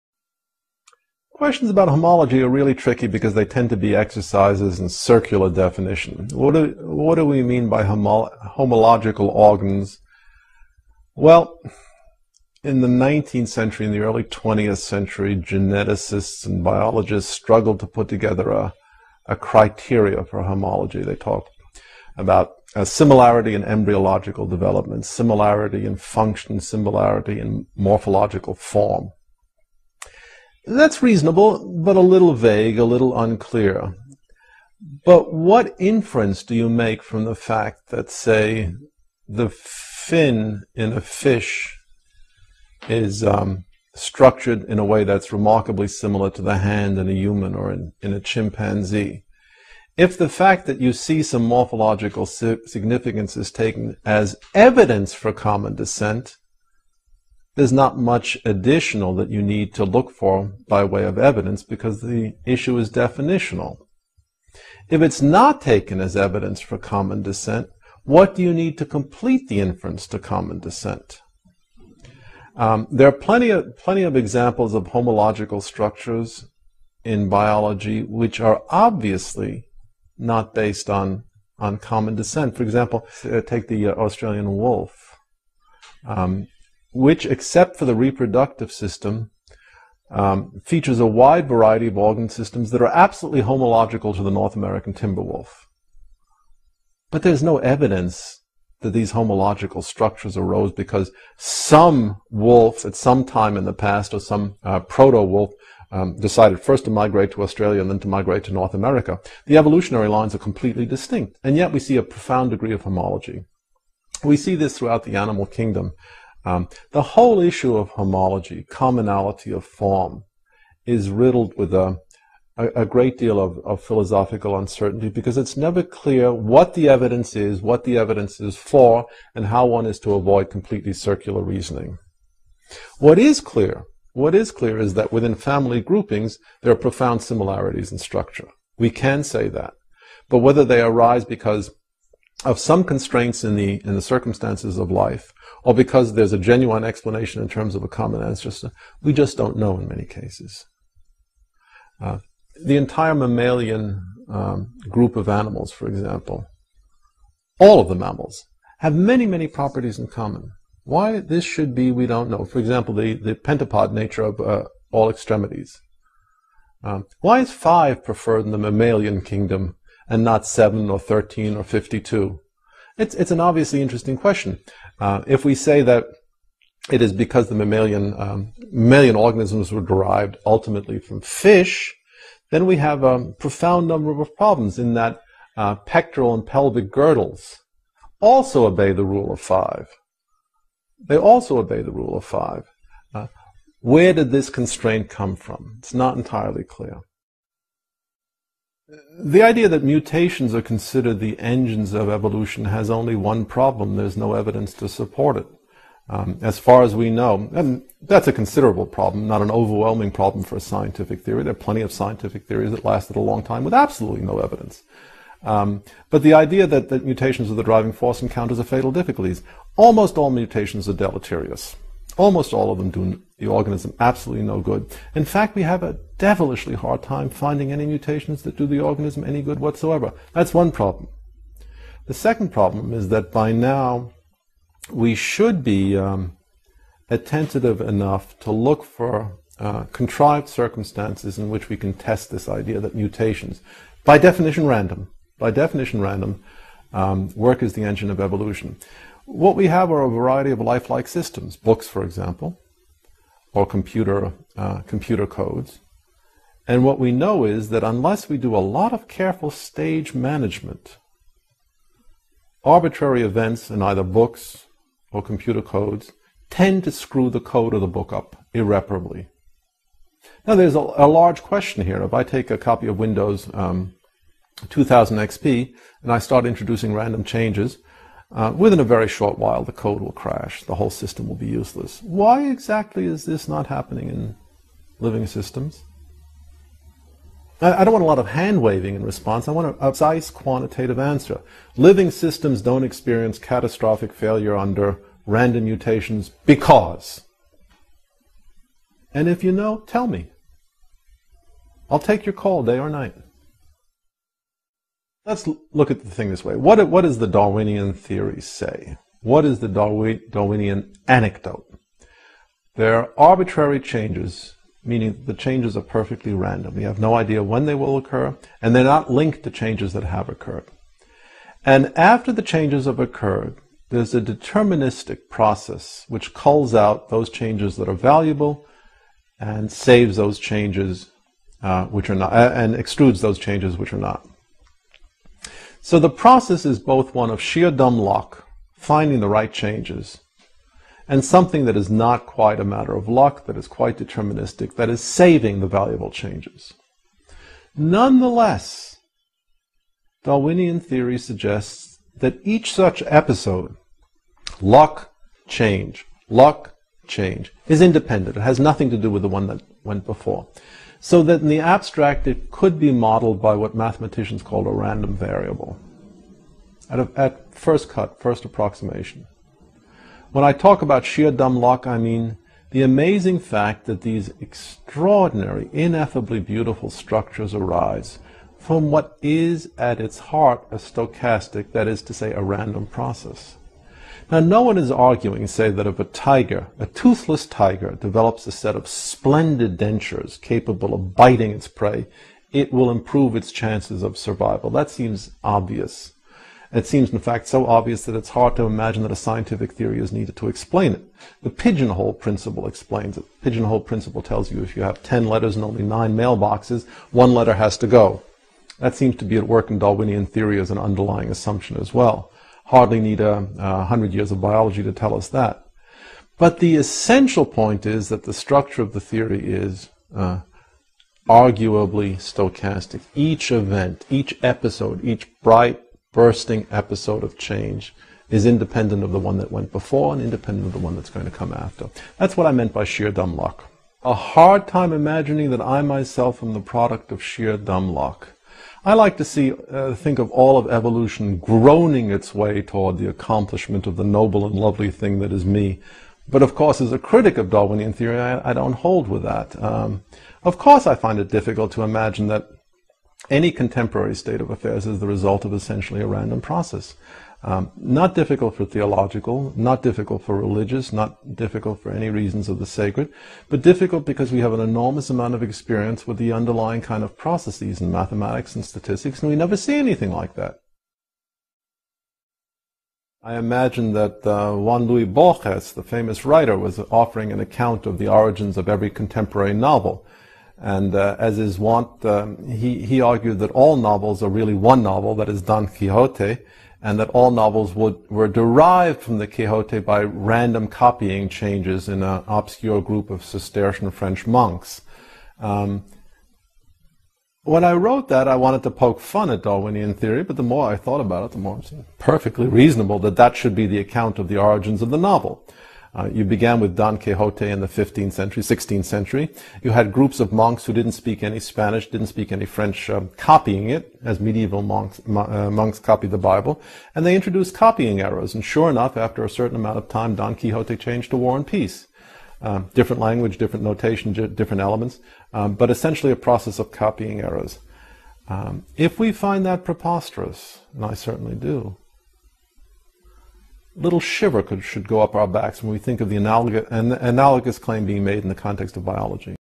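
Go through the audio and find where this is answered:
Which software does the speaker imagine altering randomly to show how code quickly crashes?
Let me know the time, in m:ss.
4:32.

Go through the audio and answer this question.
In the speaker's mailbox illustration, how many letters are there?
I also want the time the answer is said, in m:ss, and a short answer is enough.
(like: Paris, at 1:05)
10, at 6:45.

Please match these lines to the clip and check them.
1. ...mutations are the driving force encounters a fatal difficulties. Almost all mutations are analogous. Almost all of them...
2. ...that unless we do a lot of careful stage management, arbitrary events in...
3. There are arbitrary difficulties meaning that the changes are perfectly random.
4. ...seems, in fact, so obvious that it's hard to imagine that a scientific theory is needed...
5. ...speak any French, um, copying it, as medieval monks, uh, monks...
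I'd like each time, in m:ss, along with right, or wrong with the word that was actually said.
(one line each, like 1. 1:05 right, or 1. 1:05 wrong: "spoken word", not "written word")
1. 3:37 wrong: "deleterious", not "analogous"
2. 4:17 right
3. 5:12 wrong: "changes", not "difficulties"
4. 6:36 right
5. 8:32 right.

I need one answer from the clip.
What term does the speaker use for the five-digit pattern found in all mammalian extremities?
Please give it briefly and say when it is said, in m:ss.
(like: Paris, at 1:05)
pentapod, at 2:43.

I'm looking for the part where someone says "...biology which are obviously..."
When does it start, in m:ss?
1:17.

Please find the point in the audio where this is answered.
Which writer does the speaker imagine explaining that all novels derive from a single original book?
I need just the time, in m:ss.
7:54.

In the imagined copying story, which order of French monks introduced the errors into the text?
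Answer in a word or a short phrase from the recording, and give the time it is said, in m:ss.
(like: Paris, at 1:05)
Cistercian, at 8:13.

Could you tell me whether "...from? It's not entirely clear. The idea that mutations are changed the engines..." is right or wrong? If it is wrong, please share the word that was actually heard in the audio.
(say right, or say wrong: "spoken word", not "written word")
wrong: "considered", not "changed".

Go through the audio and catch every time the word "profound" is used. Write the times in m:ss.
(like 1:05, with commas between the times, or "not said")
1:52, 2:16, 3:03.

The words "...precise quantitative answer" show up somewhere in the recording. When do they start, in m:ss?
4:49.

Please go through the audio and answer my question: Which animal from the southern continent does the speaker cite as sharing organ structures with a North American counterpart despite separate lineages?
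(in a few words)
Australian wolf.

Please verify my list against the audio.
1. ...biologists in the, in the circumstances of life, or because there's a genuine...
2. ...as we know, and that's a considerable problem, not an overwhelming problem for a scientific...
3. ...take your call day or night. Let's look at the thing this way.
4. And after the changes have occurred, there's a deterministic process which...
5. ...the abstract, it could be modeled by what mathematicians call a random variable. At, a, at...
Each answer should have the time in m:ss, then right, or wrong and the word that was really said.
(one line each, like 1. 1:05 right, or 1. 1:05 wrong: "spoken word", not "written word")
1. 2:22 wrong: "constraints", not "biologists"
2. 3:26 right
3. 5:01 right
4. 5:21 right
5. 6:01 right.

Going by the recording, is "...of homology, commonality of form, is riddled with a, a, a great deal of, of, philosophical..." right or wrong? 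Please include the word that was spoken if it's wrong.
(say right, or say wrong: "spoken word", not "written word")
right.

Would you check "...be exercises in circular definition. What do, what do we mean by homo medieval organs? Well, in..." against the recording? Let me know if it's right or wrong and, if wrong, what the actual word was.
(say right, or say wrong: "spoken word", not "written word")
wrong: "homological", not "medieval".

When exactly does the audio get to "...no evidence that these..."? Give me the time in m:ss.
1:37.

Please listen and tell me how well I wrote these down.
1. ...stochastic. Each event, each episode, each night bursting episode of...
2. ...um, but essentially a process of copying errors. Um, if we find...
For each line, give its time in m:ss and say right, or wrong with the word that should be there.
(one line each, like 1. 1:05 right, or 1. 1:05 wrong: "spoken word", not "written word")
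1. 7:02 wrong: "bright", not "night"
2. 8:45 right.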